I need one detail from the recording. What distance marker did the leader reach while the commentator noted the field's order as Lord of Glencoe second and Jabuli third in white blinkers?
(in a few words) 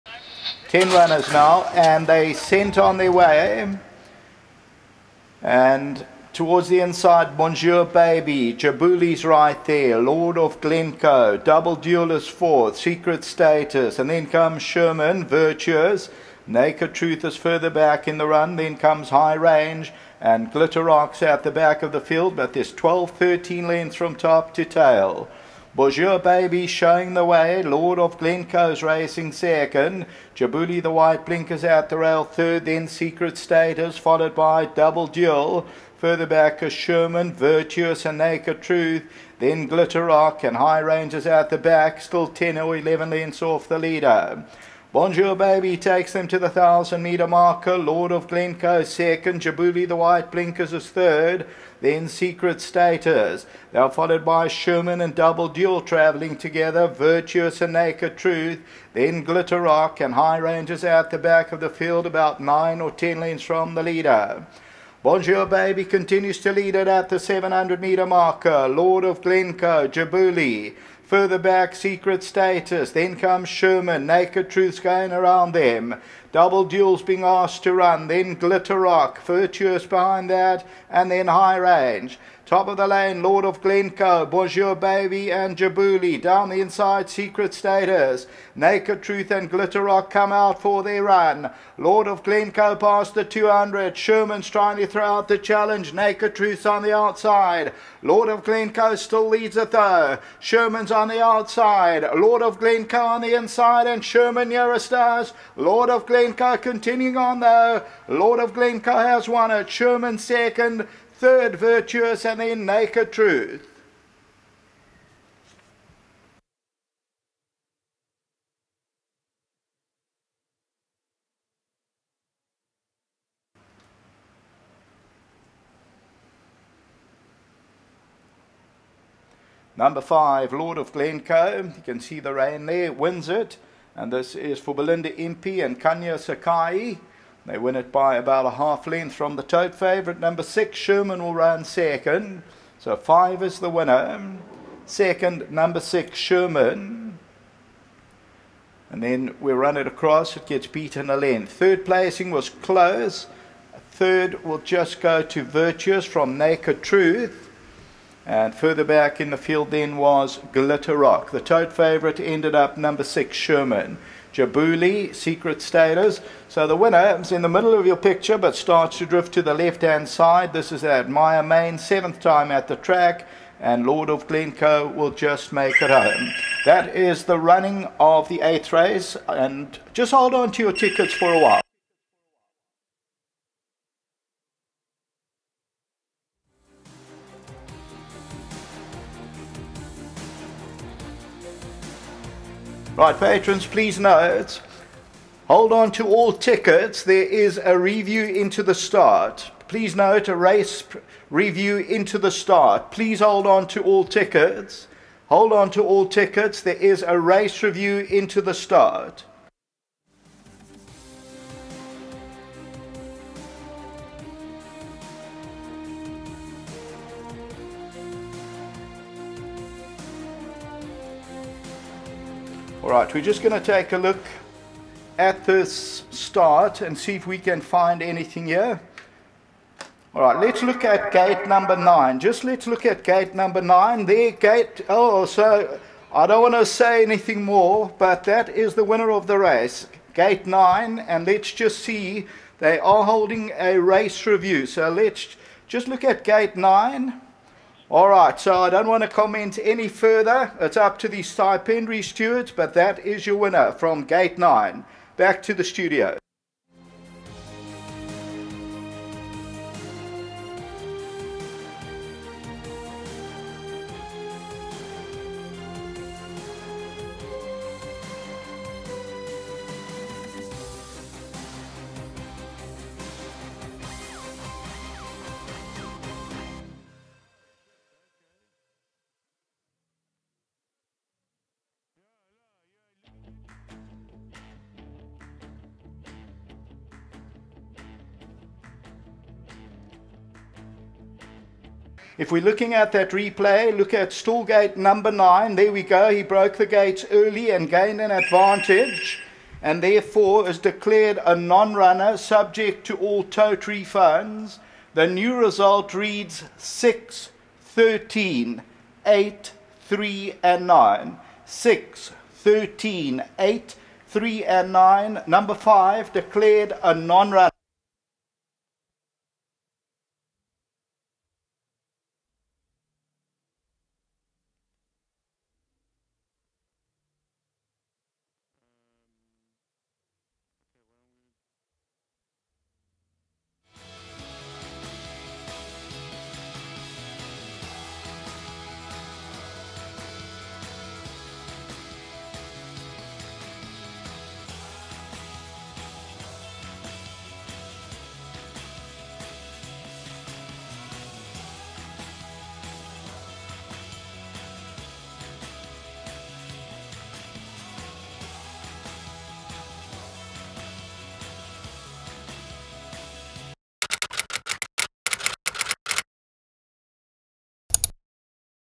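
1000 metre marker.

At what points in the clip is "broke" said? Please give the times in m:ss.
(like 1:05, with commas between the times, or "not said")
4:56.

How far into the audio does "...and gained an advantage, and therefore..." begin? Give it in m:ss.
4:57.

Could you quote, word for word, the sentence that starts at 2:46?
So the winner is in the middle of your picture but starts to drift to the left hand side.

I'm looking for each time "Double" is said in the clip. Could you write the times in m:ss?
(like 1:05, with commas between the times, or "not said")
0:11, 0:34, 0:55, 1:16.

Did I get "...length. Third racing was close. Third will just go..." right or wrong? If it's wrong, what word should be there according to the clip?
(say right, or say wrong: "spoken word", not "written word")
wrong: "placing", not "racing".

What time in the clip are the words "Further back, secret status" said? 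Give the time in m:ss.
1:11.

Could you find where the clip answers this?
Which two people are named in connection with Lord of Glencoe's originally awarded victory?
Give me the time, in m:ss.
2:14.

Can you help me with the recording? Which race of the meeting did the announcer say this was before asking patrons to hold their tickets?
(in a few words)
Eighth race.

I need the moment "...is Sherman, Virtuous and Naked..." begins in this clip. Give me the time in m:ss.
0:36.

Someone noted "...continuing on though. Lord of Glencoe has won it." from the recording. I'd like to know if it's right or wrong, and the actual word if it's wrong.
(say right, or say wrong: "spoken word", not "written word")
right.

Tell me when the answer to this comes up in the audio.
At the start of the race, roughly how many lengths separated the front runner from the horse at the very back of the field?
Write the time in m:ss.
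0:22.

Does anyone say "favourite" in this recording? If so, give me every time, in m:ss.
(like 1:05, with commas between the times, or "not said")
2:19, 2:41.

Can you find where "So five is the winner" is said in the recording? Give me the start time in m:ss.
2:22.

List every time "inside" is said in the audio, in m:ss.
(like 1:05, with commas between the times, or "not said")
0:06, 1:26, 1:43.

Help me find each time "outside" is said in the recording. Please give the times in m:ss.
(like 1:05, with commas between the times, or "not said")
1:36, 1:41.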